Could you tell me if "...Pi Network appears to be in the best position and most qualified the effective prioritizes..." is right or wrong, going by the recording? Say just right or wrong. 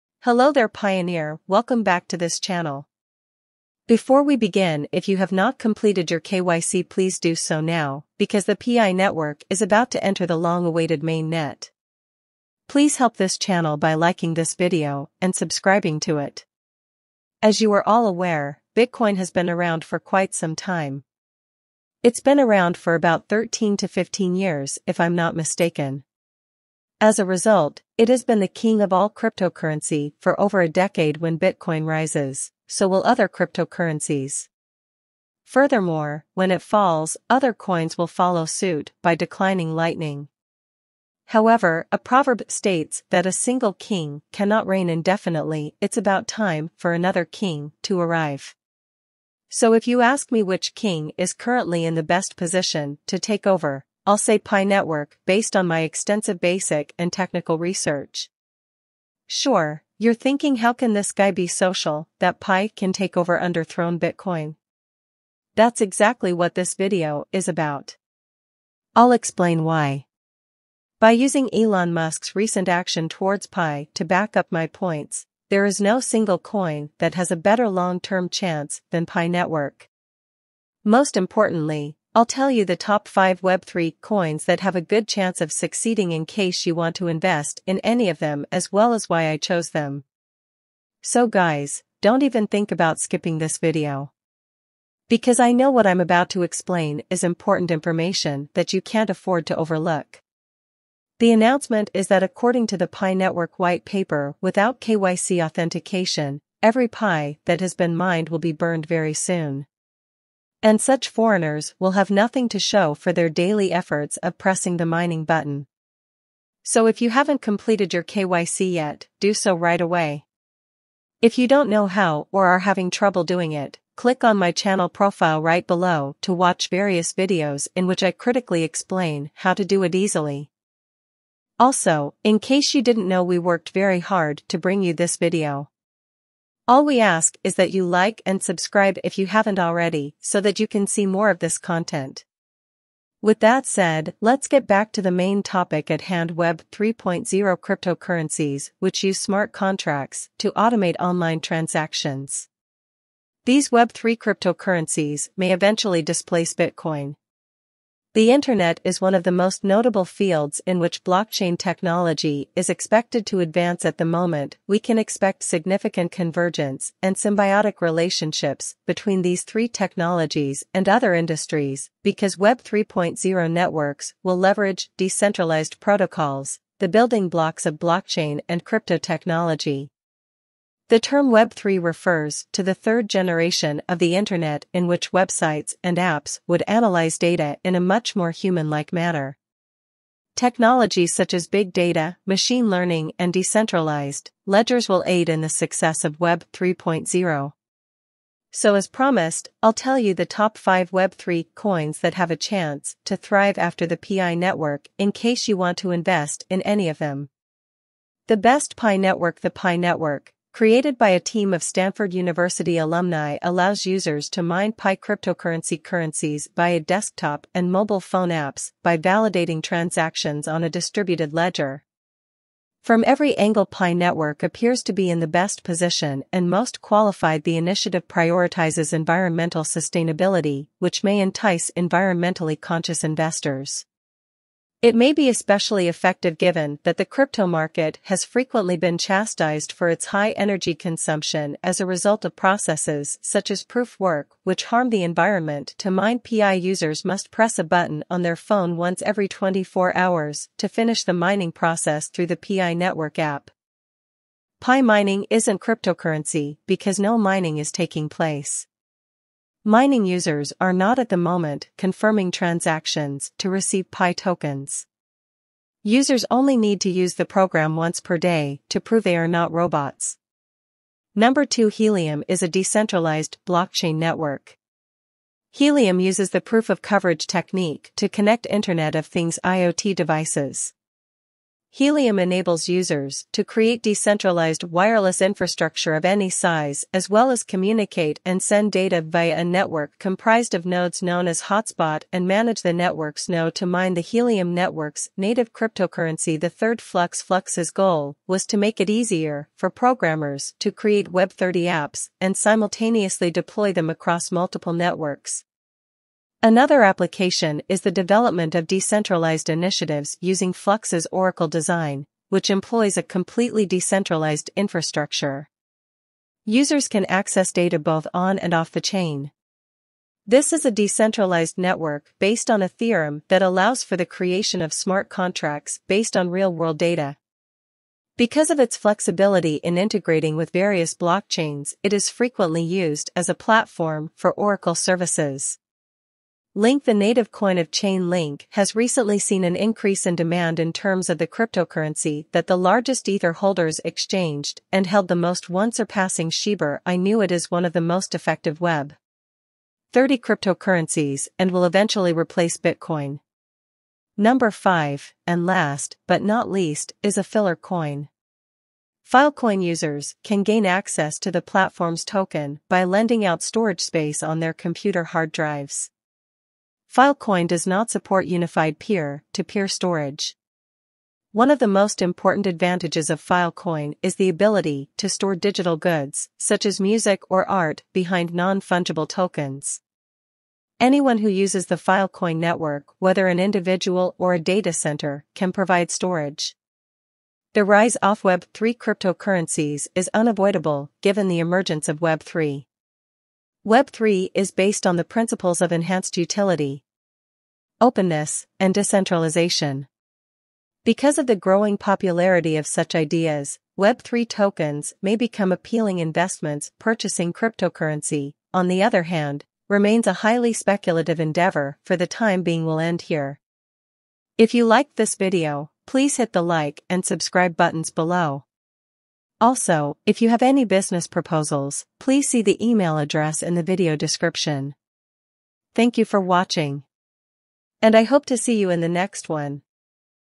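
wrong.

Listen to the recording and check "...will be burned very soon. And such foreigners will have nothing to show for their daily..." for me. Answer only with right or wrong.
right.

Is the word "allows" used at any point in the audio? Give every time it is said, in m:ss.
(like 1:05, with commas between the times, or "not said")
3:33, 5:23.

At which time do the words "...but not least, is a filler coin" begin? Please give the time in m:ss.
5:56.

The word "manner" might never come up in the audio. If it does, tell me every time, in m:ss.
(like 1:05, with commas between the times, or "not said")
3:08.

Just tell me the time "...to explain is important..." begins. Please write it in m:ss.
1:36.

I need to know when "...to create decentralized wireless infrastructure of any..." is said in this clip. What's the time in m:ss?
4:43.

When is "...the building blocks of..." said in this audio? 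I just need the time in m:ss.
2:56.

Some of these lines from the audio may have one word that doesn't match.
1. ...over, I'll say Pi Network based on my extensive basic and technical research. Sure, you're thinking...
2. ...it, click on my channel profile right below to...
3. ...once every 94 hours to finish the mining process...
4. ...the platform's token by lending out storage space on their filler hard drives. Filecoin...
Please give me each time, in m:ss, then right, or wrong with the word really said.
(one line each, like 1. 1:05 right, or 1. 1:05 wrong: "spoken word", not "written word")
1. 0:53 right
2. 2:03 right
3. 4:08 wrong: "24", not "94"
4. 6:01 wrong: "computer", not "filler".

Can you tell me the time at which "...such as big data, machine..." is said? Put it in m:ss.
3:11.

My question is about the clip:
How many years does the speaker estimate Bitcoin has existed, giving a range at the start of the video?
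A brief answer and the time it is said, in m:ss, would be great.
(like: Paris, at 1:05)
13 to 15 years, at 0:23.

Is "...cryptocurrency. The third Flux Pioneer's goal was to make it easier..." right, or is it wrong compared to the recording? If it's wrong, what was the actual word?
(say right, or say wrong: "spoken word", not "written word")
wrong: "Flux", not "Pioneer".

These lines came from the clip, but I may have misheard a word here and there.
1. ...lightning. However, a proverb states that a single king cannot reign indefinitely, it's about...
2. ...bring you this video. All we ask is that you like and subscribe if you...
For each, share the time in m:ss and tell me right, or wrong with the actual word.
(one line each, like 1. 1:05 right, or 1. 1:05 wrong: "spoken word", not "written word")
1. 0:39 right
2. 2:14 right.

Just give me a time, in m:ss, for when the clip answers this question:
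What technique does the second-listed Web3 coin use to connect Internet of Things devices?
4:36.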